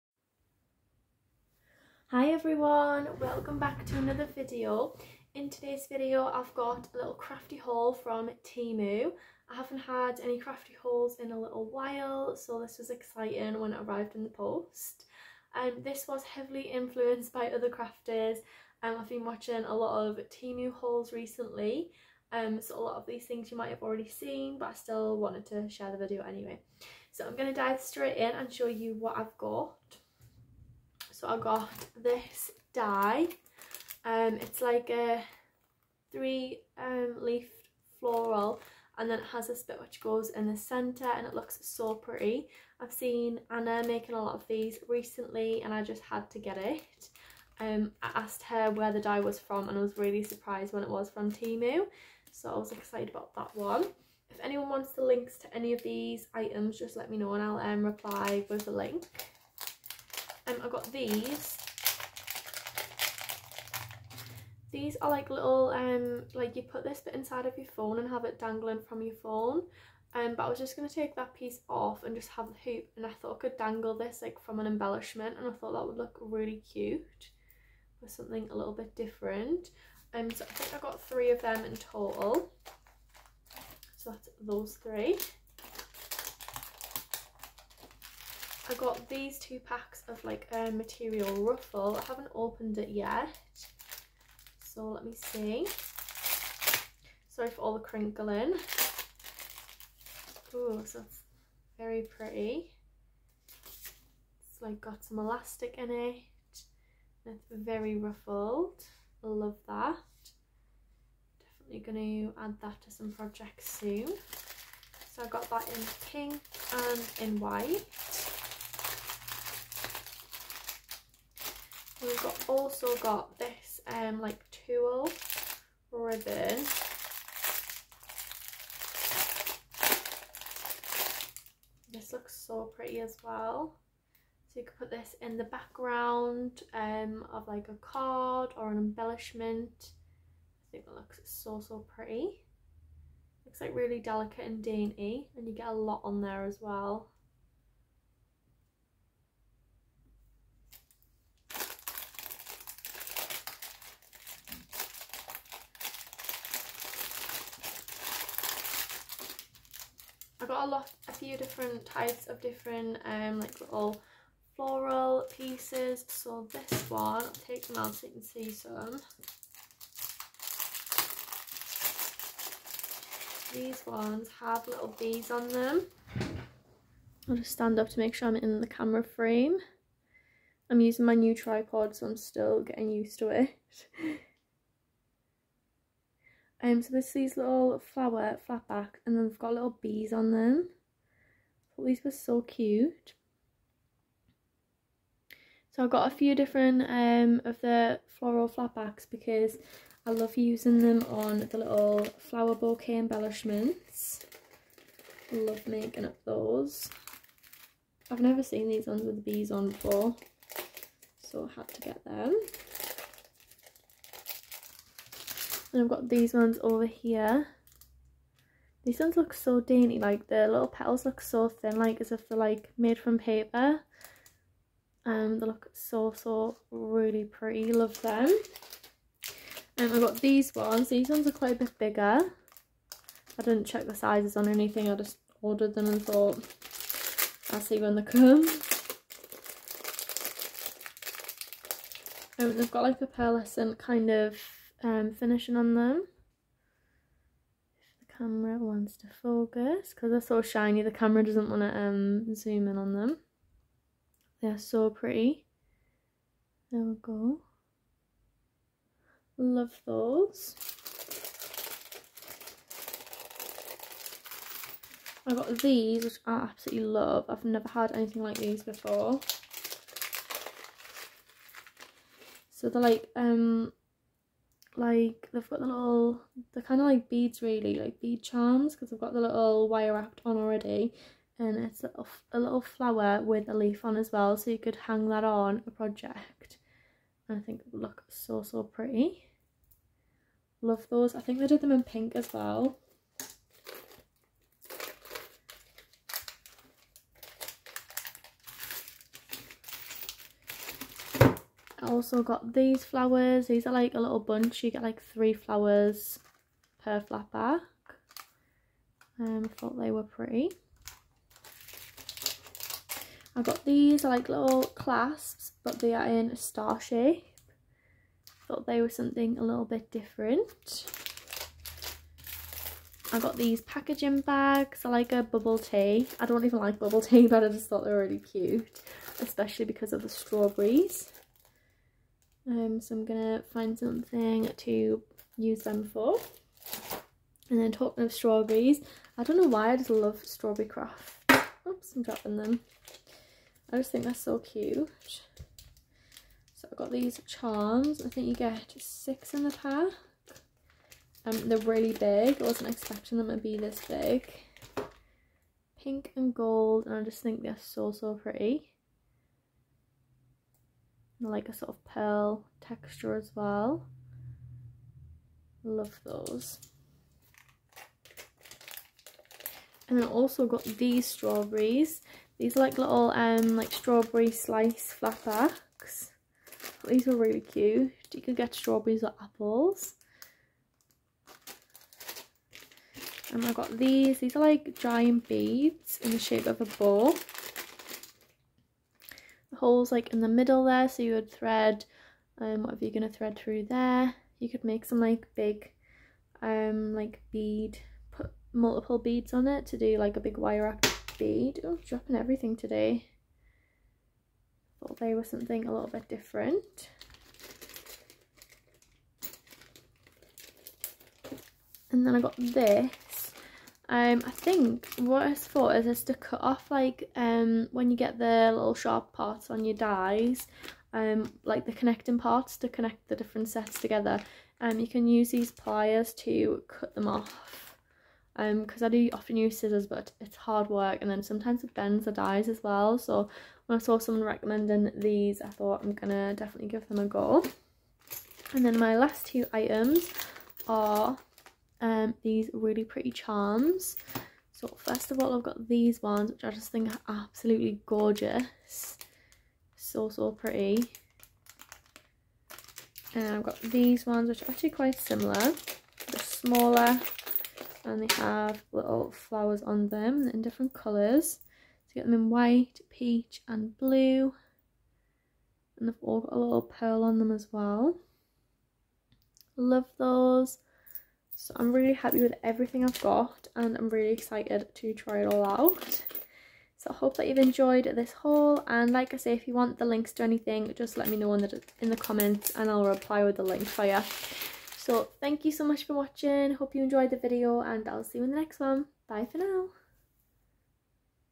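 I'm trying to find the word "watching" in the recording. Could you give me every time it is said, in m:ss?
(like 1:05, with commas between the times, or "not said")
0:19, 8:05.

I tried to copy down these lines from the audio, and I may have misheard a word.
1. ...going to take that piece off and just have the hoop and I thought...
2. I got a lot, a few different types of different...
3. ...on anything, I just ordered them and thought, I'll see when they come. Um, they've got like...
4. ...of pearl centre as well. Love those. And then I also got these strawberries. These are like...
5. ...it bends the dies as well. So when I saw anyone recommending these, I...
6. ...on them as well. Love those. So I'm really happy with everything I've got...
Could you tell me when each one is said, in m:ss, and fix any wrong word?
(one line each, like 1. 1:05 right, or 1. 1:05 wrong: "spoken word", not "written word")
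1. 1:10 right
2. 2:40 right
3. 3:54 right
4. 6:01 wrong: "texture", not "centre"
5. 7:11 wrong: "someone", not "anyone"
6. 7:47 right.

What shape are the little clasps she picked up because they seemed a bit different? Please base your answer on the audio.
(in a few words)
Star.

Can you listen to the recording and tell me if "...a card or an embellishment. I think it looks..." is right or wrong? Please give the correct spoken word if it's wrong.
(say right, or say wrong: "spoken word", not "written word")
right.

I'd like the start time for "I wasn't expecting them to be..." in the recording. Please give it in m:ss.
5:52.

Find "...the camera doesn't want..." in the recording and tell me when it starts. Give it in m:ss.
4:10.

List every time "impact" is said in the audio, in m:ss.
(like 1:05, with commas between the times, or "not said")
not said.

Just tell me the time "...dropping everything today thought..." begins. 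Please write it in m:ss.
6:41.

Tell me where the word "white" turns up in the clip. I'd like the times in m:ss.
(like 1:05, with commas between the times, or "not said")
1:57, 7:42.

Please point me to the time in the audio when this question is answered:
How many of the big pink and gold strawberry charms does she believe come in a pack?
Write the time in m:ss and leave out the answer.
5:48.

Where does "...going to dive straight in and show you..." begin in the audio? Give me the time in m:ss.
0:27.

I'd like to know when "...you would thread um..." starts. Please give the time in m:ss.
6:31.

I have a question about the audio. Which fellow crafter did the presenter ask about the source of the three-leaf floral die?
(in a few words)
Anna.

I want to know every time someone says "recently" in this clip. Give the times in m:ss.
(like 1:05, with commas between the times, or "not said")
0:21, 0:44.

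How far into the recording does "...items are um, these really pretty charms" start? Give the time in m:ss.
7:19.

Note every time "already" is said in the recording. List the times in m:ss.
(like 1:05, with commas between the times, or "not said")
0:23, 4:40.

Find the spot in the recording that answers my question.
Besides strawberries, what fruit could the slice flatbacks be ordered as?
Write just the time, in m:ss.
6:19.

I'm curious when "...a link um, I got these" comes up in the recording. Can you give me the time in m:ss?
0:58.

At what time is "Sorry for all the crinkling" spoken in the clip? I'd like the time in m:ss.
1:37.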